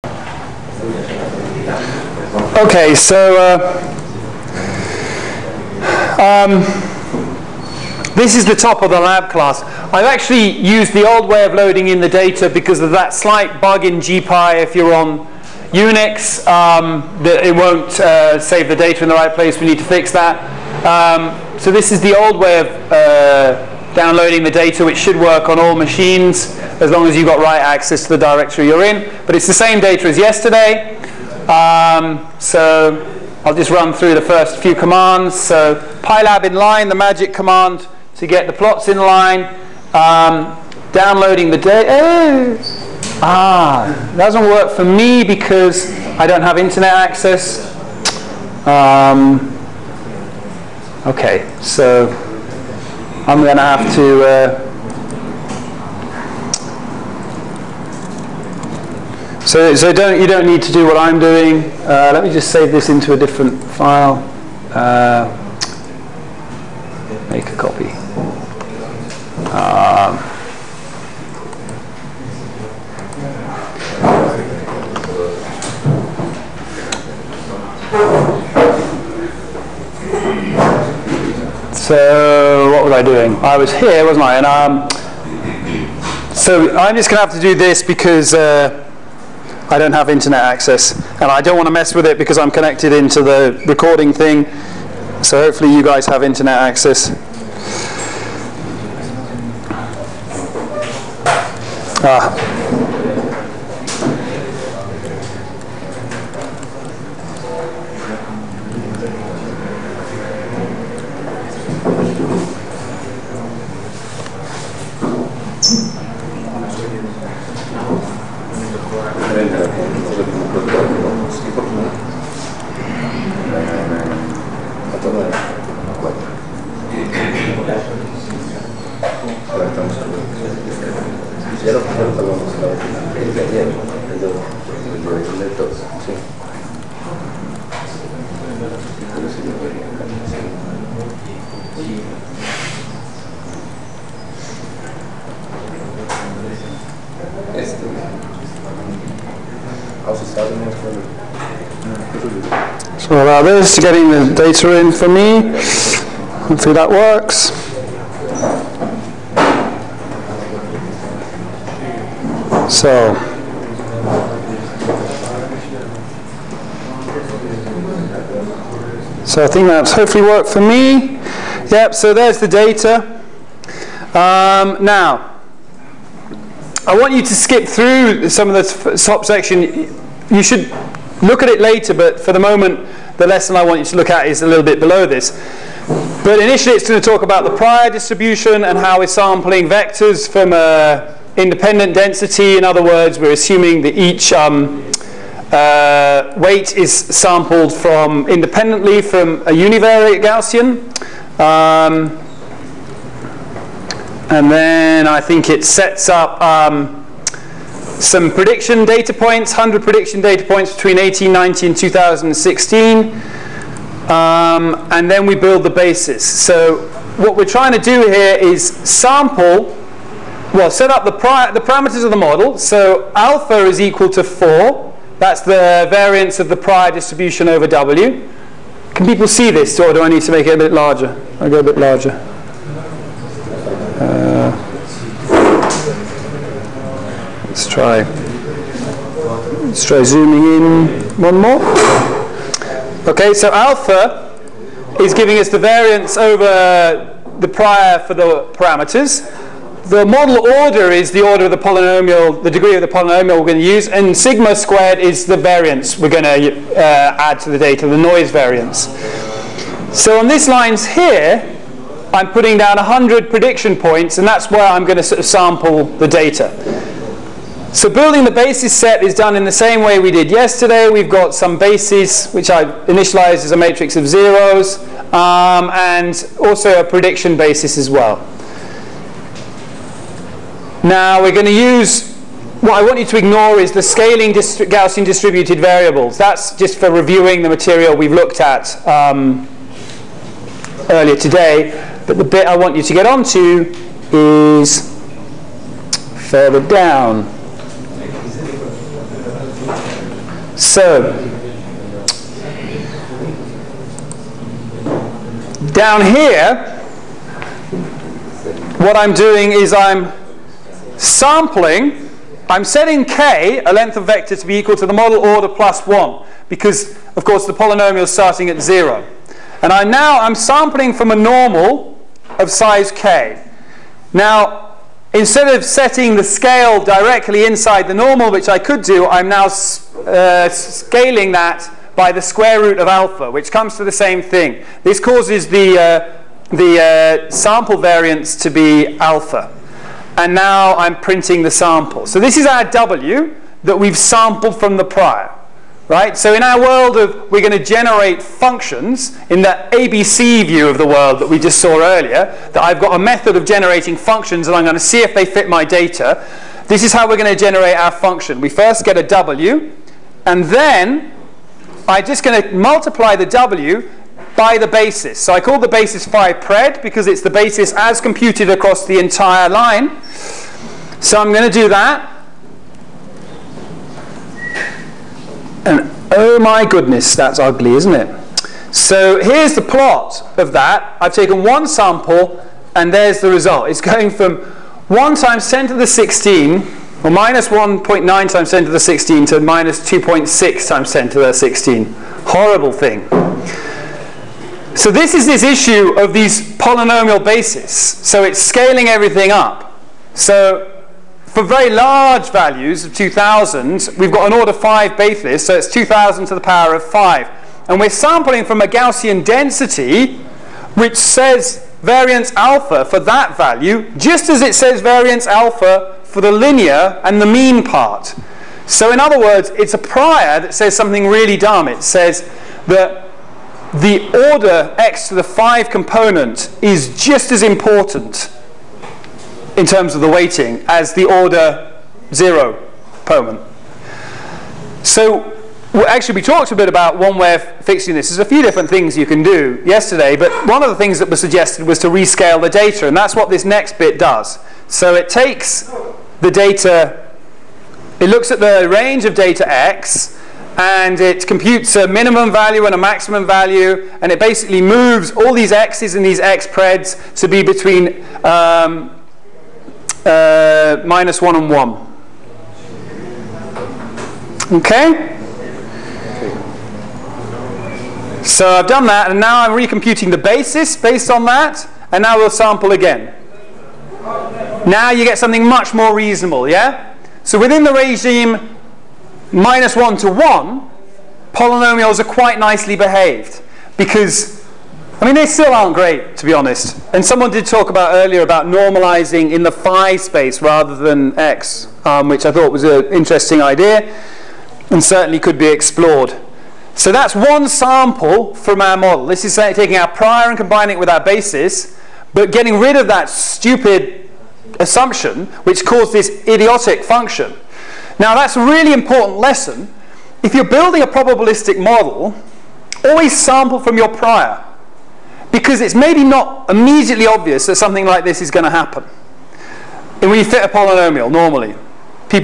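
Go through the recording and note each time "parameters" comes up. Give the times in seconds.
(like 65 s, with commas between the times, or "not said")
221 s, 248 s.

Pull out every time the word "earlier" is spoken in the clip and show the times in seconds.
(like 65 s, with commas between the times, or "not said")
290 s, 351 s, 487 s.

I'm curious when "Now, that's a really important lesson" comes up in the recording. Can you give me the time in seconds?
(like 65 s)
507 s.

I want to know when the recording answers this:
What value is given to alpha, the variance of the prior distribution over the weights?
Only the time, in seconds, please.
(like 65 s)
223 s.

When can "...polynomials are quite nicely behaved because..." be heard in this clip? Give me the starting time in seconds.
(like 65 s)
481 s.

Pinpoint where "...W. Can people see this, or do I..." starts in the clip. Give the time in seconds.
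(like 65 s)
227 s.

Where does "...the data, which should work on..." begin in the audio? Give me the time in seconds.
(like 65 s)
24 s.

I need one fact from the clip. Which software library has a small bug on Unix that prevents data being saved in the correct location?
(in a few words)
GPy.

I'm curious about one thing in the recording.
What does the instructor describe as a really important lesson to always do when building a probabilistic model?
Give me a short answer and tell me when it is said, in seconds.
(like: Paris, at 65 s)
sample from your prior, at 512 s.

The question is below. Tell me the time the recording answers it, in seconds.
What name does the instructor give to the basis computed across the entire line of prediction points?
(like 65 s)
366 s.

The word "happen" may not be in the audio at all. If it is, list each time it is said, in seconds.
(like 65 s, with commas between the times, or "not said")
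518 s.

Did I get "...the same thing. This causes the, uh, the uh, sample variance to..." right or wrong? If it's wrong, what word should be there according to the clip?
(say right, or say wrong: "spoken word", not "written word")
right.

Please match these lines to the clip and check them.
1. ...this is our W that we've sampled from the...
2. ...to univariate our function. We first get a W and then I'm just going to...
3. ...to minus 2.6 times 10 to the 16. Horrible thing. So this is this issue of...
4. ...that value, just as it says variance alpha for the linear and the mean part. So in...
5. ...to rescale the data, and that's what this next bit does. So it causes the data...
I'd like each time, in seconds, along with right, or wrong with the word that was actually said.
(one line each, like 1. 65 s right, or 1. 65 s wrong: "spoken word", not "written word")
1. 342 s right
2. 357 s wrong: "generate", not "univariate"
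3. 389 s right
4. 412 s right
5. 441 s wrong: "takes", not "causes".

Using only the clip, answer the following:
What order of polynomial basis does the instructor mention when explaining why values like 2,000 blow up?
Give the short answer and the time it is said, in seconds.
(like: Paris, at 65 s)
5, at 404 s.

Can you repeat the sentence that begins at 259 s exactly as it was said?
So on these lines here, I'm putting down 100 prediction points, and that's where I'm going to sort of sample the data.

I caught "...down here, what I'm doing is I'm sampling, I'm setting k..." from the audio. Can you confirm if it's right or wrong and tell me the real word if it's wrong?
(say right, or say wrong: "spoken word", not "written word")
right.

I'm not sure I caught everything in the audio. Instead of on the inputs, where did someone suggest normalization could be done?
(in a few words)
the phi space.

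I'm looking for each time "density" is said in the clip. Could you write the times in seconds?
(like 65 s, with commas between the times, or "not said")
191 s, 409 s.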